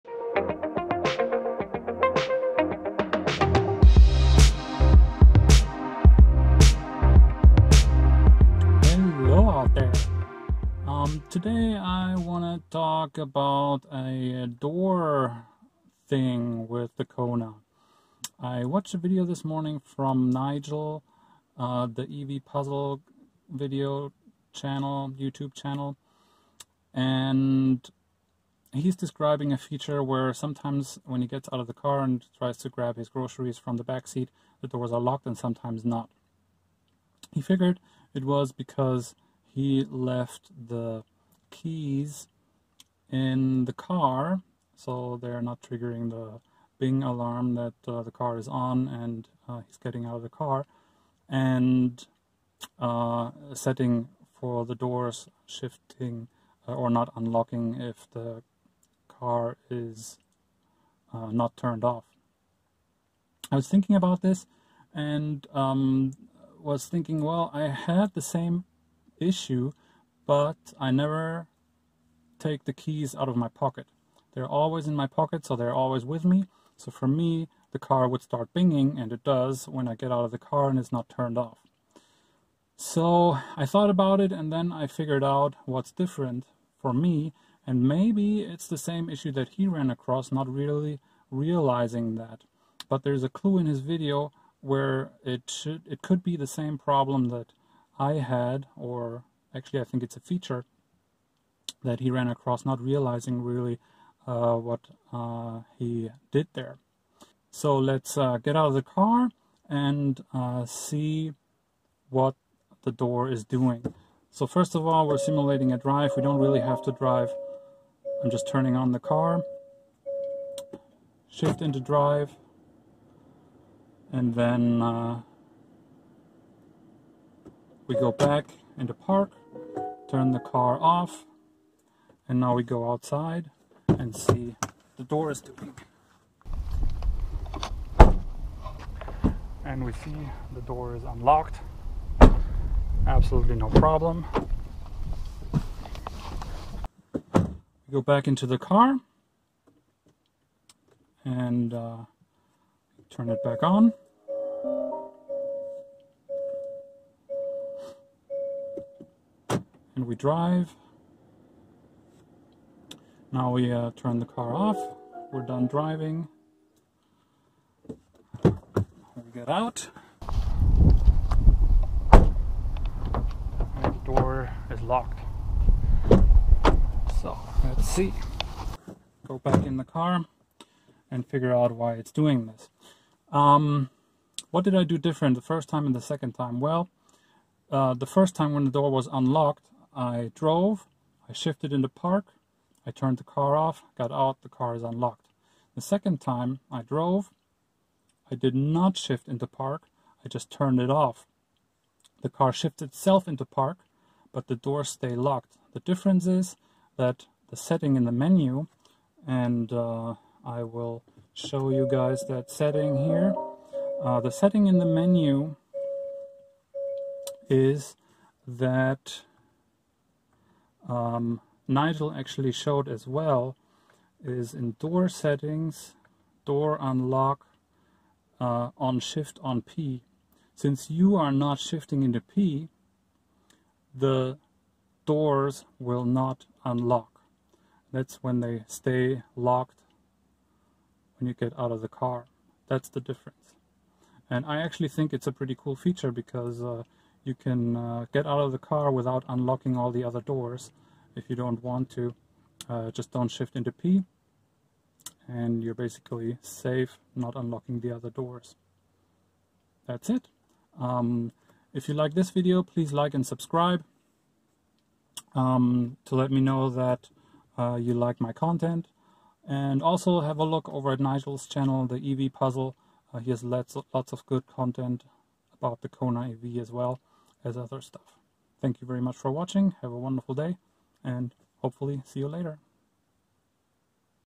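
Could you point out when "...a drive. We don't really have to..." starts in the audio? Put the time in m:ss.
1:55.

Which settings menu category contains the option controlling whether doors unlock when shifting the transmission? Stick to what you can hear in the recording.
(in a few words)
Door settings.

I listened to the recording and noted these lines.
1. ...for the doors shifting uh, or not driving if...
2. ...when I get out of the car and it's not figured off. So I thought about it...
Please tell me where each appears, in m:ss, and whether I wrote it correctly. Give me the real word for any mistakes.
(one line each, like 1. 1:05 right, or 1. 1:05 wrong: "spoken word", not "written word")
1. 0:54 wrong: "unlocking", not "driving"
2. 1:19 wrong: "turned", not "figured".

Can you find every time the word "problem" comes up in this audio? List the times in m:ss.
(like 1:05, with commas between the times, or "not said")
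1:36, 2:23.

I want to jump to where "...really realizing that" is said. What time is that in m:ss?
1:30.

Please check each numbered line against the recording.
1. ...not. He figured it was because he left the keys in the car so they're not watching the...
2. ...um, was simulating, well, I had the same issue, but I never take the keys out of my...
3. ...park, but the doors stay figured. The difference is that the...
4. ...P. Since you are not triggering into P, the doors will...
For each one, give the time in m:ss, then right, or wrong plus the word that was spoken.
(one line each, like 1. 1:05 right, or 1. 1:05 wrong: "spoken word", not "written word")
1. 0:35 wrong: "triggering", not "watching"
2. 1:05 wrong: "thinking", not "simulating"
3. 3:23 wrong: "locked", not "figured"
4. 3:49 wrong: "shifting", not "triggering".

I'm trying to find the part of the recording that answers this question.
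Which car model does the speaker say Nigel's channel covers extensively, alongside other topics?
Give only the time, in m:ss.
4:35.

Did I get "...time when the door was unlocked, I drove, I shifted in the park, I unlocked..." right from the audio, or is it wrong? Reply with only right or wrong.
wrong.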